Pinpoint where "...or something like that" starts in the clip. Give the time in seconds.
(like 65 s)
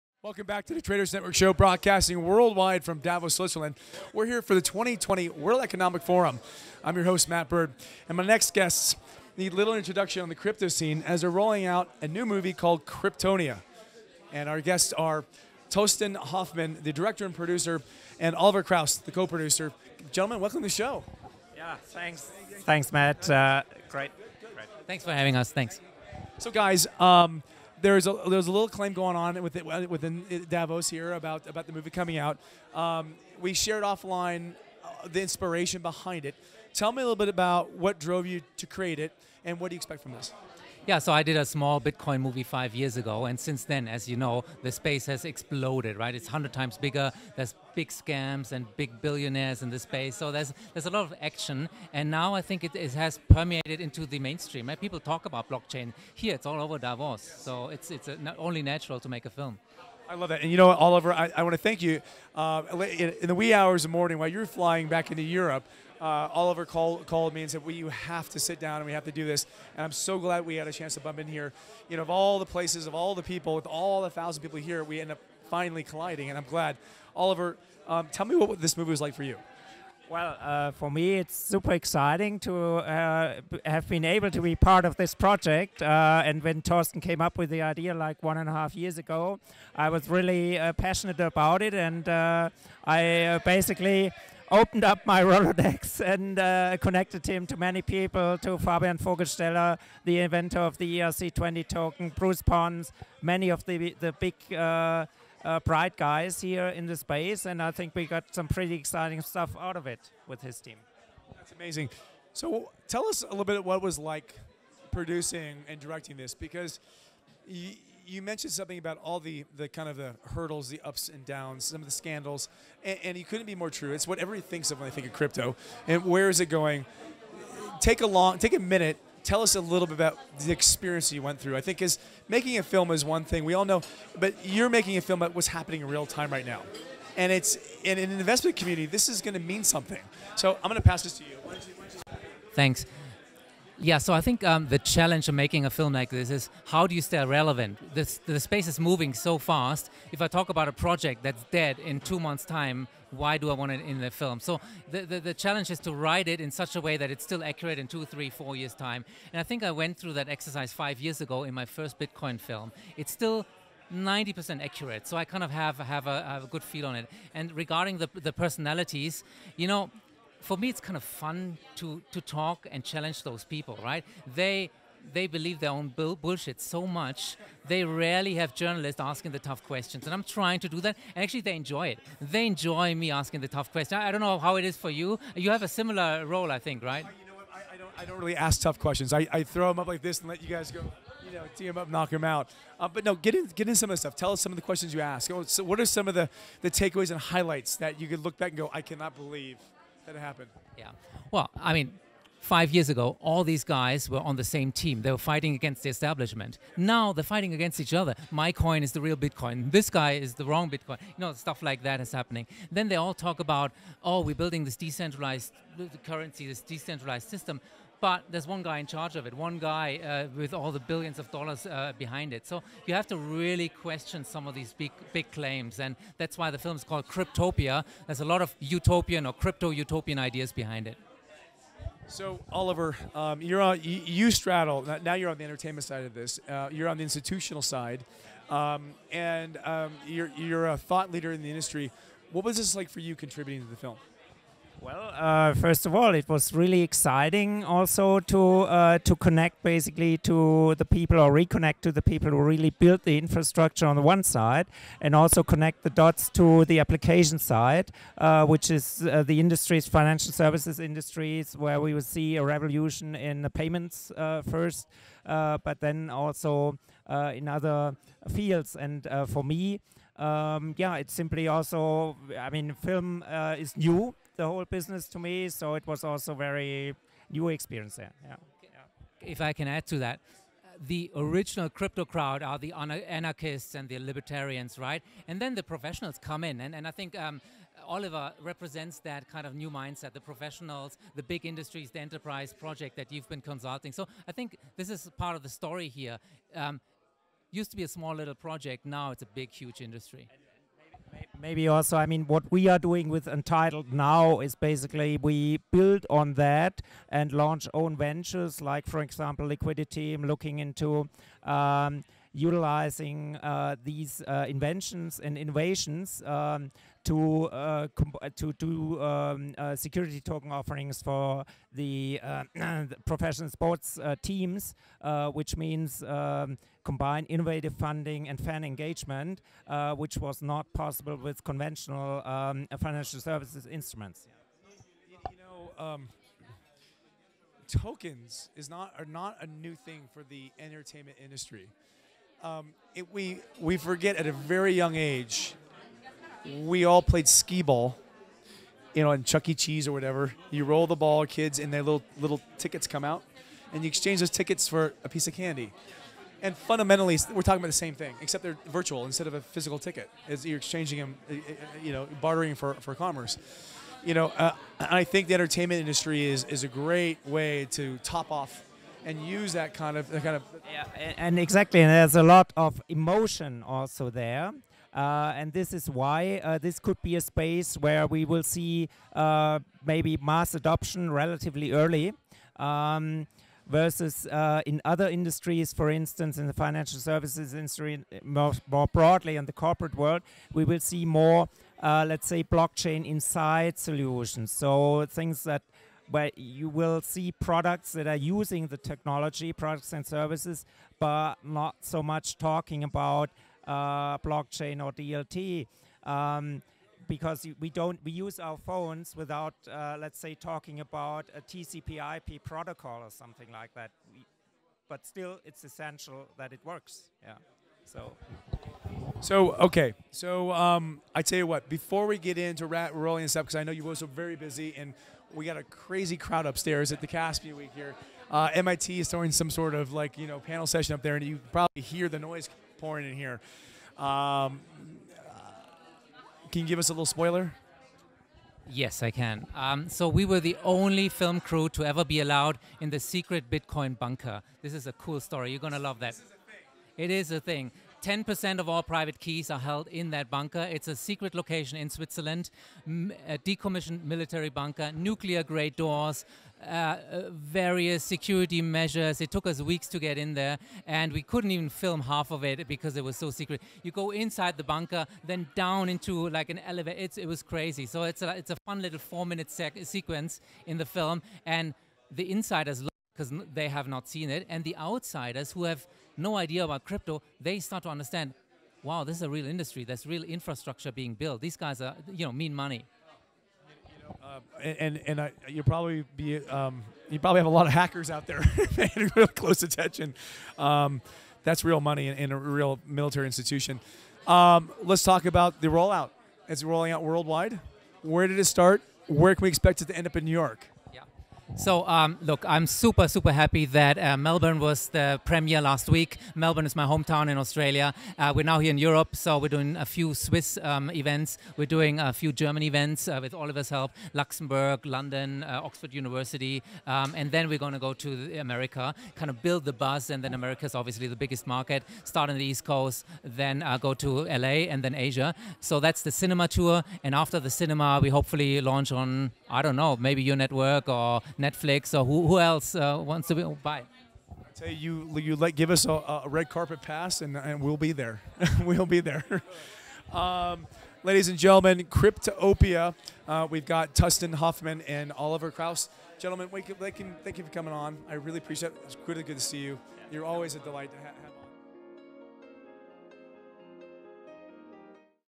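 413 s.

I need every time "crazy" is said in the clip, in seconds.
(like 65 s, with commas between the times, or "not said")
425 s, 467 s.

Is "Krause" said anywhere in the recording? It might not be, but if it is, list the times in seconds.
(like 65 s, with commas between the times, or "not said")
18 s, 545 s.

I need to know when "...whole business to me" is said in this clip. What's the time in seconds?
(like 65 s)
274 s.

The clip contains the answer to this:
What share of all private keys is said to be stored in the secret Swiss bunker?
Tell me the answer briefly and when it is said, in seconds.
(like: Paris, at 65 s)
10%, at 448 s.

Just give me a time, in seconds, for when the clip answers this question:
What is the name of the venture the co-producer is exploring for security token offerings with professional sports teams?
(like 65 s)
309 s.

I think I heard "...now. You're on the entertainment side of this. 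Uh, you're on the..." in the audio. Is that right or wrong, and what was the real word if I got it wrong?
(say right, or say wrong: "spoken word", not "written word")
right.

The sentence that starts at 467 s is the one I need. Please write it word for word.
So it's a, it's a fun little four minute sequence in the film, and the insiders because they have not seen it.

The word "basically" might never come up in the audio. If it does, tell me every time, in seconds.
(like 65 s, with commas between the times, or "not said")
93 s, 249 s, 304 s.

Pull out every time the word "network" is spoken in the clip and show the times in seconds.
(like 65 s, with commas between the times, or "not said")
1 s, 530 s.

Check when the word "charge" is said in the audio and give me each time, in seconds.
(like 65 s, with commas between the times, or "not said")
218 s.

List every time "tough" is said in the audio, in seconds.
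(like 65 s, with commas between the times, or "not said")
179 s, 183 s, 188 s.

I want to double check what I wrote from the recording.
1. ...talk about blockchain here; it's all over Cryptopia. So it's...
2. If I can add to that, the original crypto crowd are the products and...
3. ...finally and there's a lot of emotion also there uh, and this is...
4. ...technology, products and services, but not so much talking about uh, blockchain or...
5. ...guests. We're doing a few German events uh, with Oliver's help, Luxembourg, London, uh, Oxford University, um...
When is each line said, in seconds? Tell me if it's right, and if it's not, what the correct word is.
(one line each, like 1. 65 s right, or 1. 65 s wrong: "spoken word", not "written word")
1. 54 s wrong: "Davos", not "Cryptopia"
2. 279 s wrong: "anarchists", not "products"
3. 371 s wrong: "exactly", not "finally"
4. 398 s right
5. 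510 s wrong: "events", not "guests".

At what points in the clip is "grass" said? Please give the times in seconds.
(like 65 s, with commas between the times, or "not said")
not said.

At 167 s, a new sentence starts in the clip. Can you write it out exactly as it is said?
And regarding the, the personalities, you know, for me, it's kind of fun to, to talk and challenge those people, right?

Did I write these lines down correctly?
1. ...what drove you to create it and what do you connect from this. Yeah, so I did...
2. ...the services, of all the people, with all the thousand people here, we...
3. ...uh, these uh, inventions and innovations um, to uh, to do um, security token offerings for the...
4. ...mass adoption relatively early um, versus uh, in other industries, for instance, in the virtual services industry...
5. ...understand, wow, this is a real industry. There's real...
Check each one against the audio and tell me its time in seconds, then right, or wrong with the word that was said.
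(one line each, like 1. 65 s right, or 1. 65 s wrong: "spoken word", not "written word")
1. 37 s wrong: "expect", not "connect"
2. 72 s wrong: "places", not "services"
3. 313 s right
4. 380 s wrong: "financial", not "virtual"
5. 477 s right.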